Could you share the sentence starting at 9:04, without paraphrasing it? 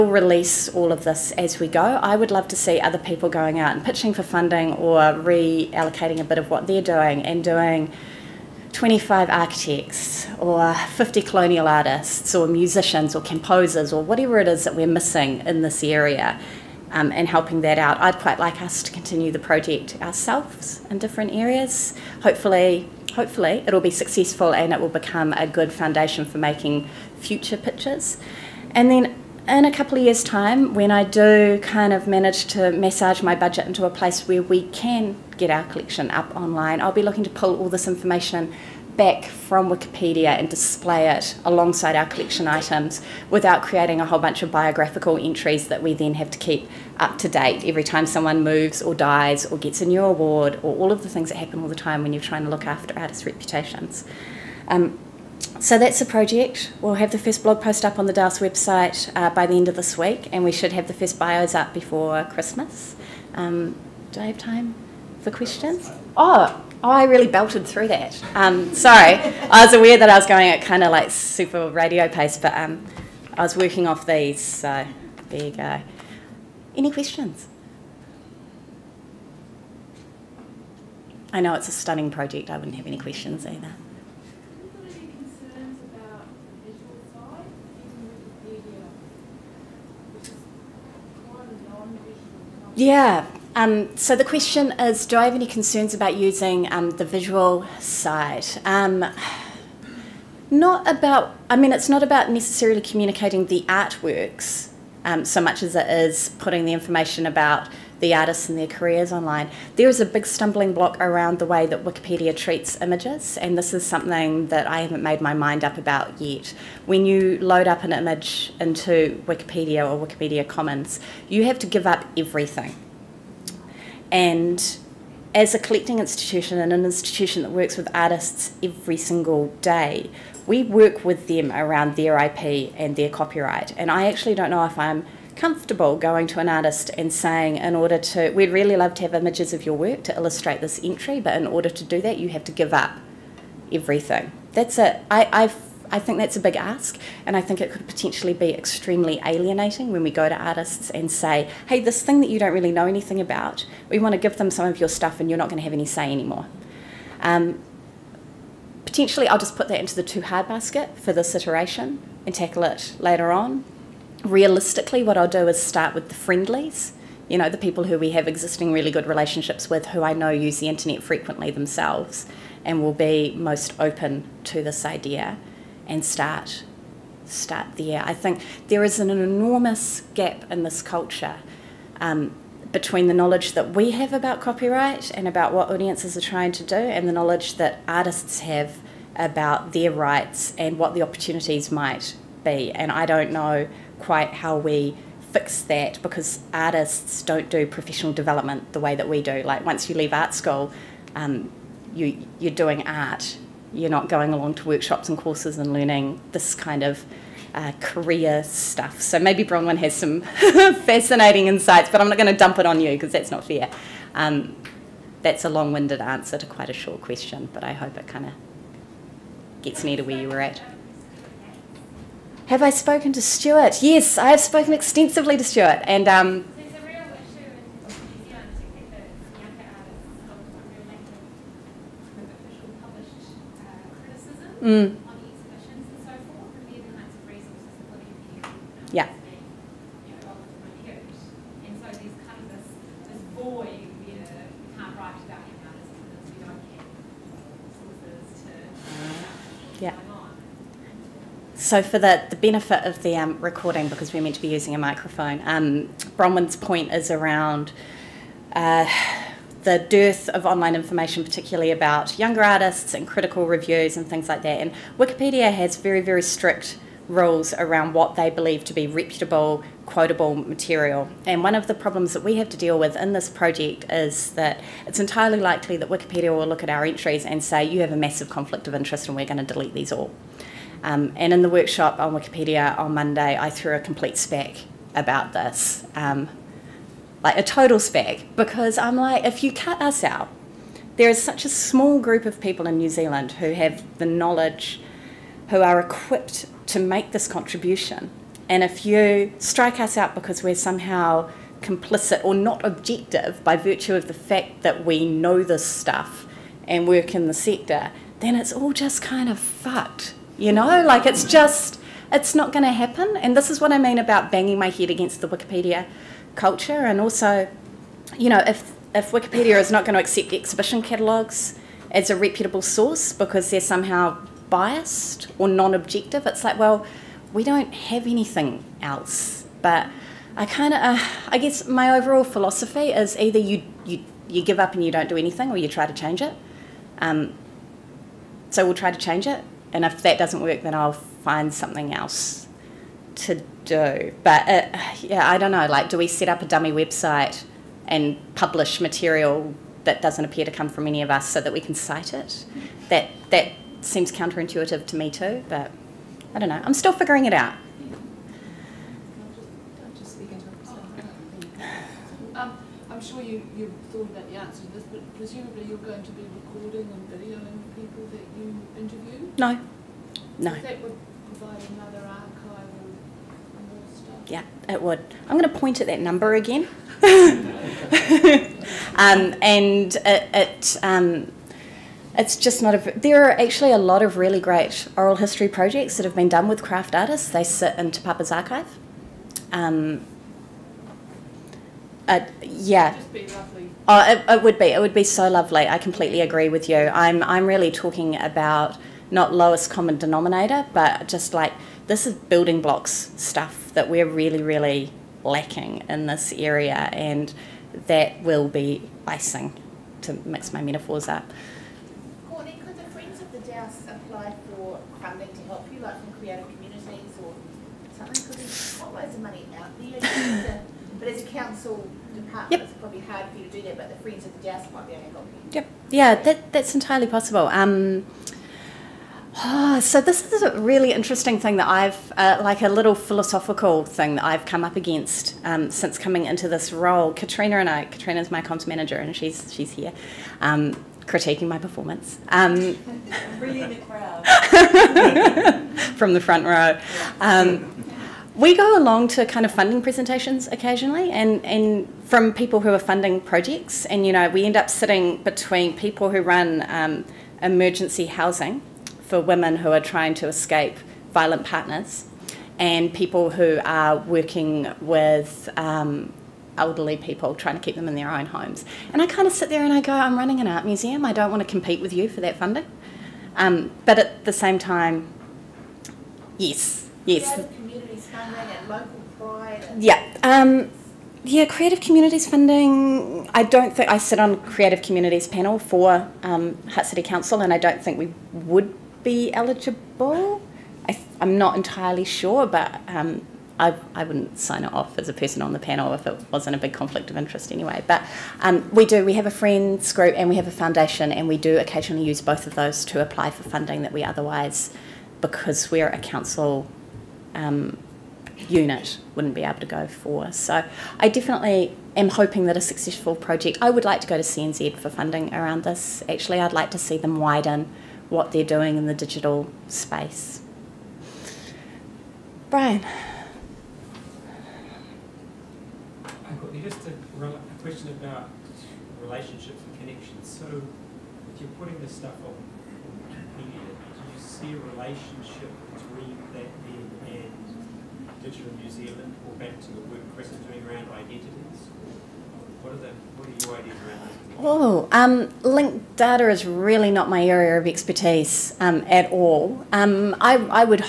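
Oh, um, linked data is really not my area of expertise um, at all.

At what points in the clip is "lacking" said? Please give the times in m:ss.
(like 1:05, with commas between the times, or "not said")
6:45.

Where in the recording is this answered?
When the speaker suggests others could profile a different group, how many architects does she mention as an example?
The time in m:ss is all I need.
0:08.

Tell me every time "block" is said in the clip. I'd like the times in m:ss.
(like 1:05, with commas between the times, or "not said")
1:50, 6:42.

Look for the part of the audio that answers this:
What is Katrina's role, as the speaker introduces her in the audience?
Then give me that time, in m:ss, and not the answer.
7:18.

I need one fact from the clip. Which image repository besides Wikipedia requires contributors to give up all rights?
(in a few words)
Wikipedia Commons.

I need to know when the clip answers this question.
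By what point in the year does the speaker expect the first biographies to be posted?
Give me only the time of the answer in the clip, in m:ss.
1:01.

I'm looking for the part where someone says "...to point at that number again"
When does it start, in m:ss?
6:15.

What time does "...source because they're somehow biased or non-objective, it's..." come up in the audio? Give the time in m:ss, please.
5:22.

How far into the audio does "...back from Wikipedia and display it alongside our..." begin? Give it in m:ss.
0:38.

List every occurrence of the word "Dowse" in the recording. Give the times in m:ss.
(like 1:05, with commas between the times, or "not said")
0:58, 6:53, 7:04.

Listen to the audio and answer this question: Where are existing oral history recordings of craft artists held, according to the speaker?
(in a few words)
Te Papa.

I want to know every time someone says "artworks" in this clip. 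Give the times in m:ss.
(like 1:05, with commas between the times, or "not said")
1:43.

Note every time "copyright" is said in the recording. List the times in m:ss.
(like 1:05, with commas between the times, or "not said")
2:13, 3:04.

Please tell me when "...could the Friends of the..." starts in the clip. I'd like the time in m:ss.
6:52.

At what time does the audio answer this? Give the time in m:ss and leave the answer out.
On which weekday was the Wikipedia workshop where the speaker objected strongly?
4:42.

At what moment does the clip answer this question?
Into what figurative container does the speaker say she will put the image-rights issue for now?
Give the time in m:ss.
2:40.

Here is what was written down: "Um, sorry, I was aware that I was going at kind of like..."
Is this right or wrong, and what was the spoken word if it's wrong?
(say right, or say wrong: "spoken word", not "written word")
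right.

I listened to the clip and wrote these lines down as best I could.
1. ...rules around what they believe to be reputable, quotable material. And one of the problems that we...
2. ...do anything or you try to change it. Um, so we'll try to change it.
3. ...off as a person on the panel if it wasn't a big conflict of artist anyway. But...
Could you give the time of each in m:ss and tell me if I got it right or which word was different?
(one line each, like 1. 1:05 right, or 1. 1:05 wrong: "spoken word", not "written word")
1. 4:27 right
2. 5:35 right
3. 8:14 wrong: "interest", not "artist".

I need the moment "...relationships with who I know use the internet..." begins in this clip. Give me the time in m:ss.
2:49.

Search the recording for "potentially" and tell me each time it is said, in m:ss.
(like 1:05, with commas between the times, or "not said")
2:27, 2:38.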